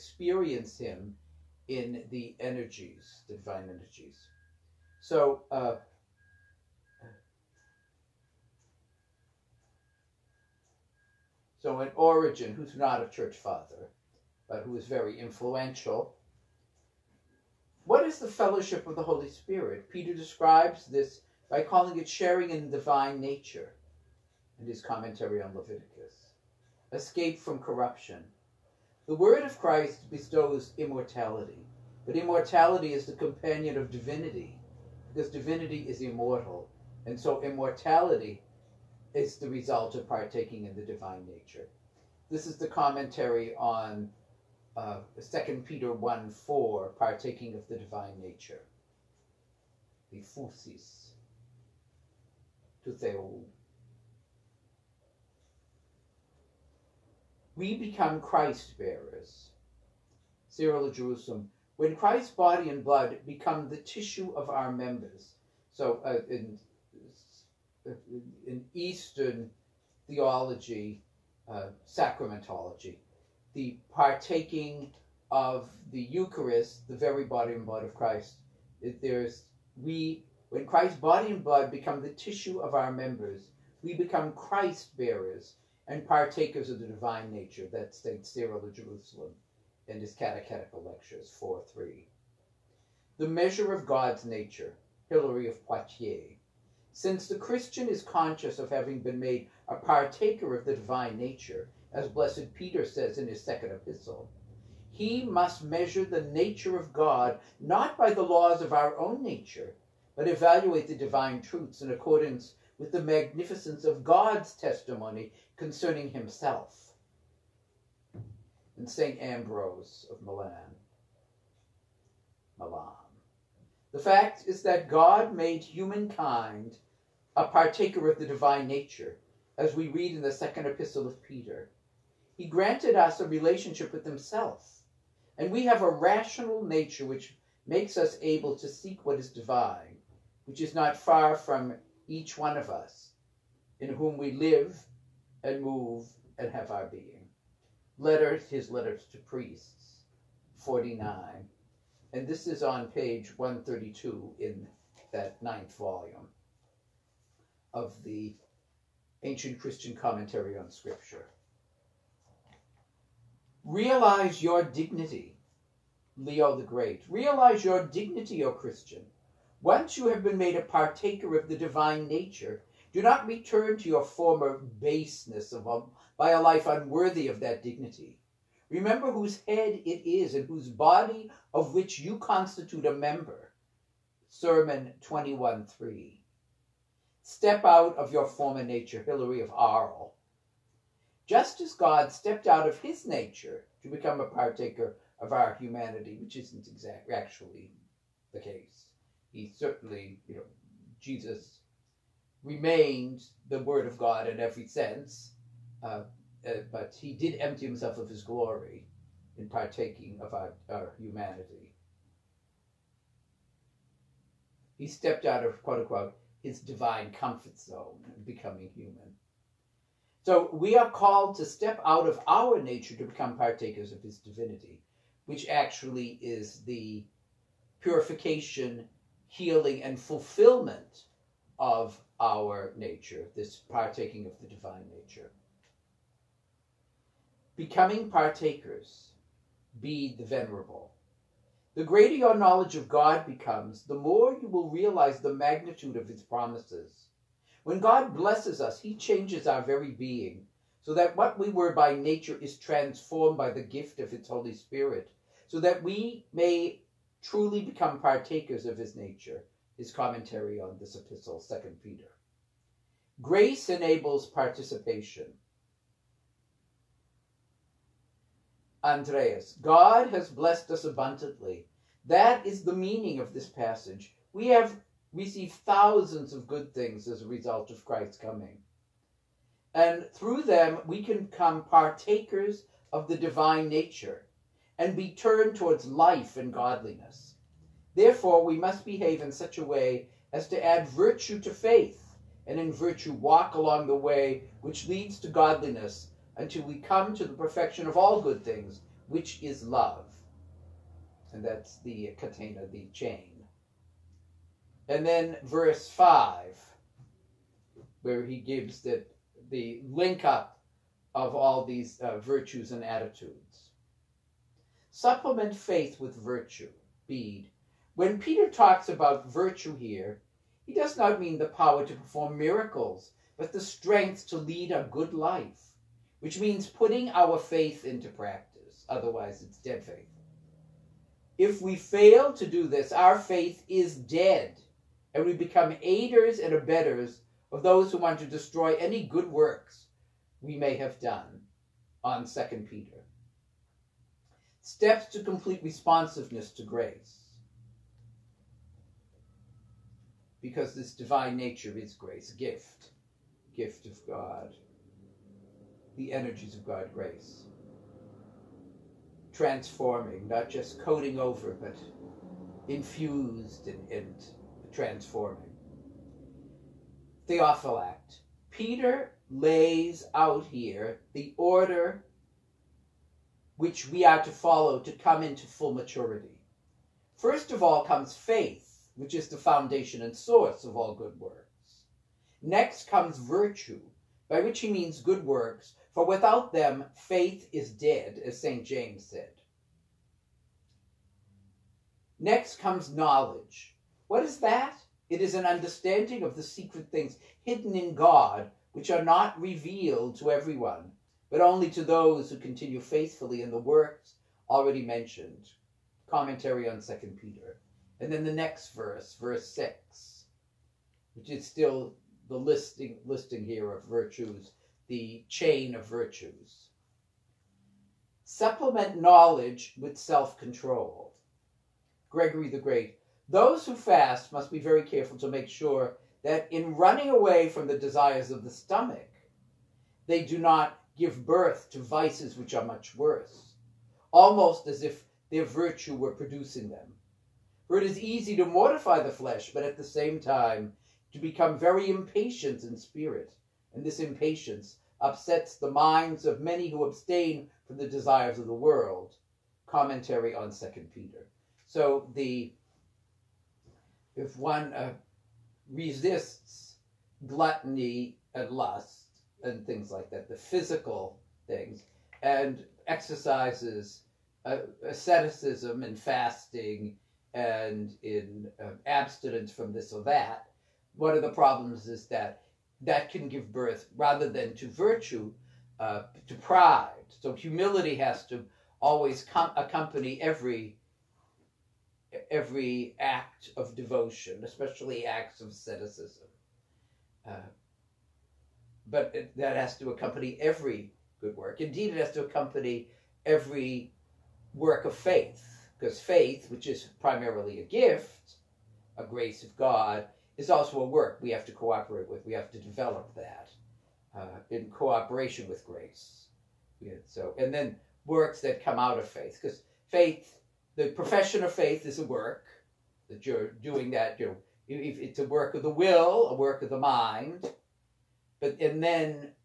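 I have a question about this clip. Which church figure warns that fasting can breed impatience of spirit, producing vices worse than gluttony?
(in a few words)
Gregory the Great.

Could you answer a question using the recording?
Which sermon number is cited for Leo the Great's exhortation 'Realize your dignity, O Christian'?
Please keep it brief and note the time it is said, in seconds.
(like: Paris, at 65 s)
21.3, at 185 s.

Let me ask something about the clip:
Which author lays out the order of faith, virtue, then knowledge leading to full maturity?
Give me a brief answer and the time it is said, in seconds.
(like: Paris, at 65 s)
Theophylact, at 367 s.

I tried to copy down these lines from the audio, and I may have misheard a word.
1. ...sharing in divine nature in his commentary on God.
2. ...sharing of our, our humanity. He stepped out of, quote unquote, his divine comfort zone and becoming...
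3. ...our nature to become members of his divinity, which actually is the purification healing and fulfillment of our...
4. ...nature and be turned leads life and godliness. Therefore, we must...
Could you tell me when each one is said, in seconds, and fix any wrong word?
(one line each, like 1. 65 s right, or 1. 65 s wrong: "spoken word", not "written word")
1. 22 s wrong: "Leviticus", not "God"
2. 209 s wrong: "partaking", not "sharing"
3. 222 s wrong: "partakers", not "members"
4. 283 s wrong: "towards", not "leads".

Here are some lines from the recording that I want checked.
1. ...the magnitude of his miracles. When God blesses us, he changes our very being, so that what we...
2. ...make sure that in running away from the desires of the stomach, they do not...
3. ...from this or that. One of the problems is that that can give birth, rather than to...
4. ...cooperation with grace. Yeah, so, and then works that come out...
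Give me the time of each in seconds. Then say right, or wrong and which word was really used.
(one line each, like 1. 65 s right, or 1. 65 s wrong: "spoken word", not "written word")
1. 245 s wrong: "promises", not "miracles"
2. 425 s right
3. 469 s right
4. 504 s right.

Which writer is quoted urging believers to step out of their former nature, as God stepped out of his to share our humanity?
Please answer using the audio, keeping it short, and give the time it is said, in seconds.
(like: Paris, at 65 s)
Hilary of Arles, at 189 s.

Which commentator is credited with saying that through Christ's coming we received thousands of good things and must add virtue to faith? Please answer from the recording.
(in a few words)
Andreas.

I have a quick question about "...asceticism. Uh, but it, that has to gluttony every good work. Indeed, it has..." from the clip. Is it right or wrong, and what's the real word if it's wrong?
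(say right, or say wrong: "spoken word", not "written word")
wrong: "accompany", not "gluttony".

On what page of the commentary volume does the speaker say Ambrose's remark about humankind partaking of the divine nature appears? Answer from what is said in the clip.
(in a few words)
132.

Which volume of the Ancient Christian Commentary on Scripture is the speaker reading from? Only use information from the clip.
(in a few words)
ninth.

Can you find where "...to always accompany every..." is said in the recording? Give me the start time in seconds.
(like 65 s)
478 s.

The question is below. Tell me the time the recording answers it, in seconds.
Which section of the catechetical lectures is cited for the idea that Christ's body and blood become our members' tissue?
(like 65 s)
91 s.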